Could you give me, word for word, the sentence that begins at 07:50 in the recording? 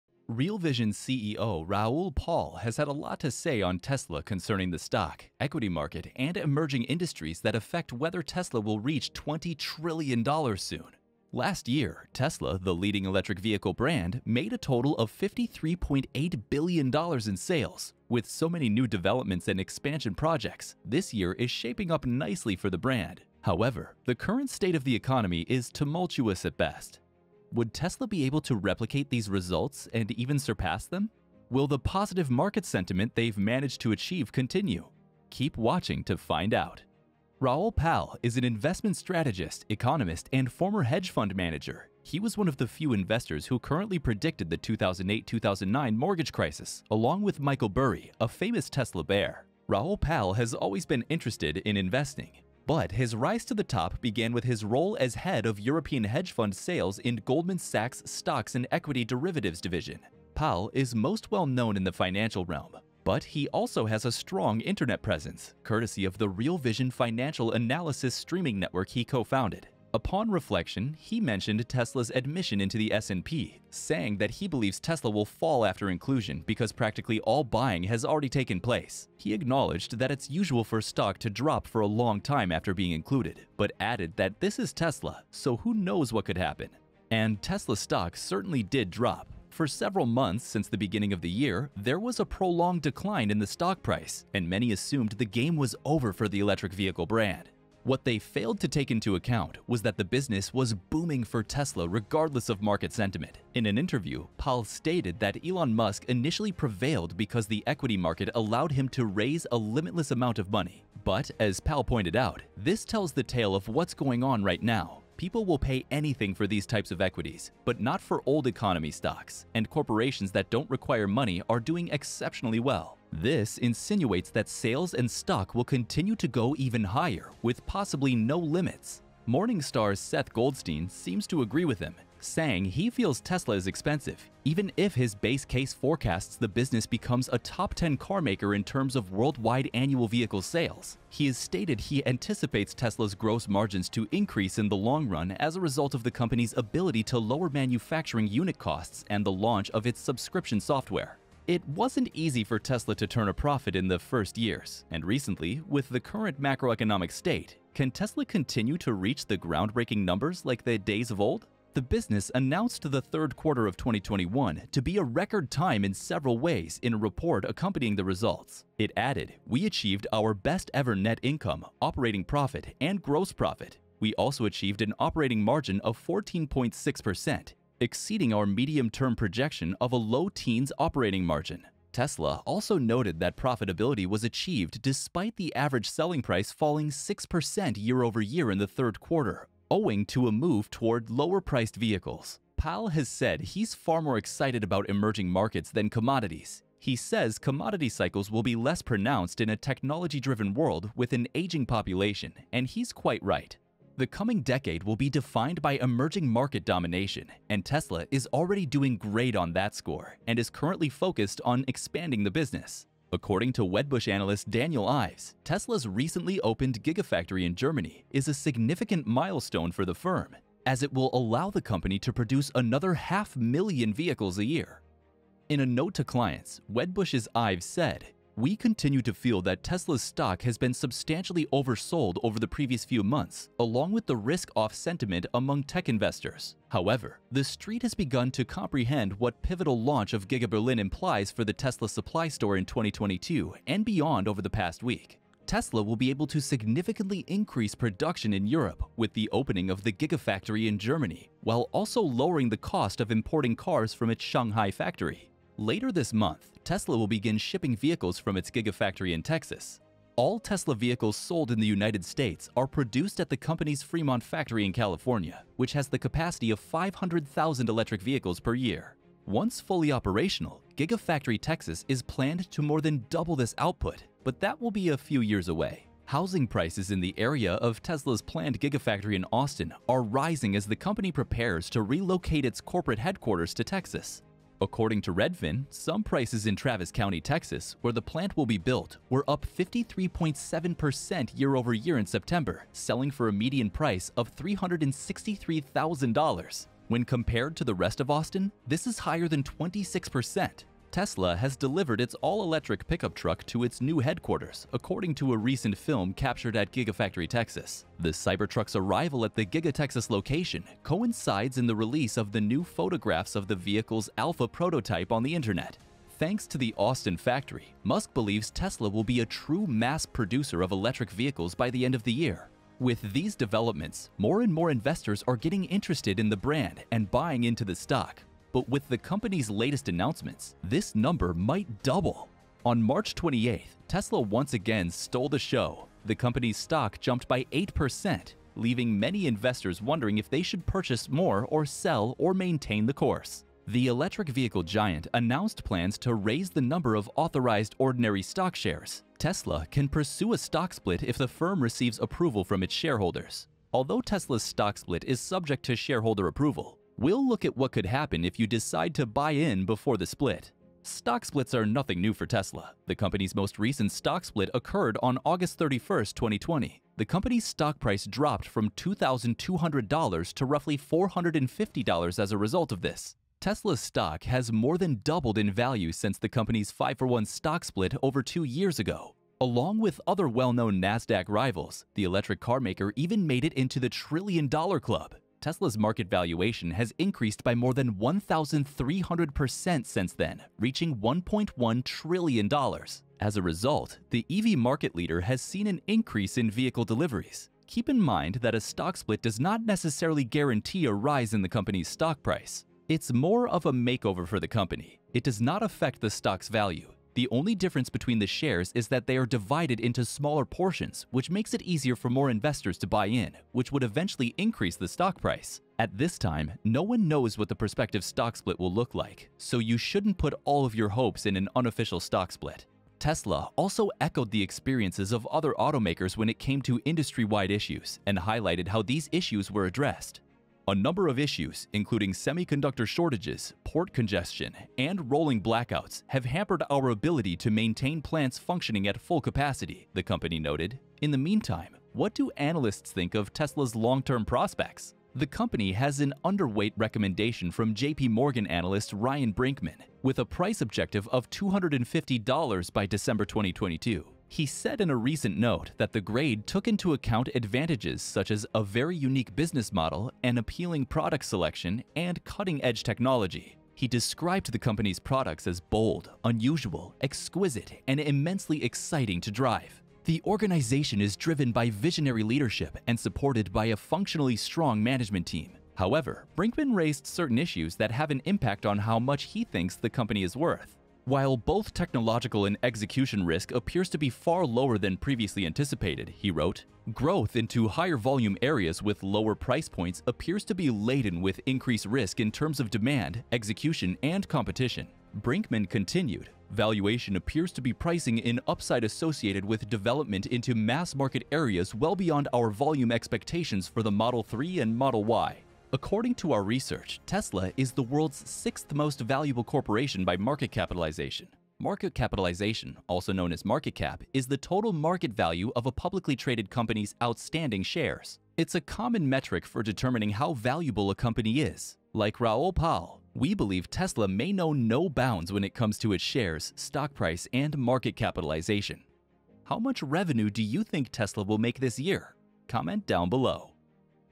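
The organization is driven by visionary leadership and supported by a functionally strong management team.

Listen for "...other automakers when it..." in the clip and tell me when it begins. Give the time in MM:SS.
07:05.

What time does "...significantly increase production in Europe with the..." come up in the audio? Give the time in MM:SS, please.
04:06.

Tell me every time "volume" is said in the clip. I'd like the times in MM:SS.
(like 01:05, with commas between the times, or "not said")
08:07, 08:22.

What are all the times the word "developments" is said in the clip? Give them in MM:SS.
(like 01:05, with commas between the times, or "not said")
00:18, 05:23, 08:19.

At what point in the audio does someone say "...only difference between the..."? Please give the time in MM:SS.
06:47.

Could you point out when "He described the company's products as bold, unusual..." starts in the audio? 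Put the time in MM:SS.
07:43.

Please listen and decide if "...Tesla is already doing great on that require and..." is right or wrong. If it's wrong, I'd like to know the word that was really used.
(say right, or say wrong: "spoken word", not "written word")
wrong: "score", not "require".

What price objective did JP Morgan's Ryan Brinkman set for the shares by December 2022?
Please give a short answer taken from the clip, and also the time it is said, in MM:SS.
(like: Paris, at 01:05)
$250, at 07:31.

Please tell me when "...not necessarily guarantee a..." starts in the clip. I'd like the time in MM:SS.
06:39.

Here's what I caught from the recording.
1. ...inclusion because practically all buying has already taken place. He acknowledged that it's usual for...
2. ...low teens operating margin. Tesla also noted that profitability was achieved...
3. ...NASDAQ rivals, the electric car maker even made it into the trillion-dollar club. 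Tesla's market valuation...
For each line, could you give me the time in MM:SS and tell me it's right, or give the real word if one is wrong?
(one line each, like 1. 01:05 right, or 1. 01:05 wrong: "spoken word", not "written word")
1. 01:15 right
2. 02:59 right
3. 06:20 right.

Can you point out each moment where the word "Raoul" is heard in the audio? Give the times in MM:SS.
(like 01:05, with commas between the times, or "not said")
00:01, 00:37, 00:49, 08:42.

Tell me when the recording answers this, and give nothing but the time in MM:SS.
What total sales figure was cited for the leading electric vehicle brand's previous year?
00:15.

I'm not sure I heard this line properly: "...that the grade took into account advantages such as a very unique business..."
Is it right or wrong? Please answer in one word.
right.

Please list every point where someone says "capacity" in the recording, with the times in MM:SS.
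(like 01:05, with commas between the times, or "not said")
04:25, 07:19.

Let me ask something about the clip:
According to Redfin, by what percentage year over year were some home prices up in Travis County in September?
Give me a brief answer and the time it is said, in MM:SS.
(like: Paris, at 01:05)
53.7%, at 04:49.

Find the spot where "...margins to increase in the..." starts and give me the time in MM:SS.
02:23.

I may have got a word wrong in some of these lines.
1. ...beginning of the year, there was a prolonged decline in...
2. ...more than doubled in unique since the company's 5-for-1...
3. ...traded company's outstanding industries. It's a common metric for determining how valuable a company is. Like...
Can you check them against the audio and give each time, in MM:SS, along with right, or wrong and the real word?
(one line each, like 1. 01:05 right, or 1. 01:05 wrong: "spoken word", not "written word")
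1. 01:30 right
2. 06:14 wrong: "value", not "unique"
3. 08:36 wrong: "shares", not "industries".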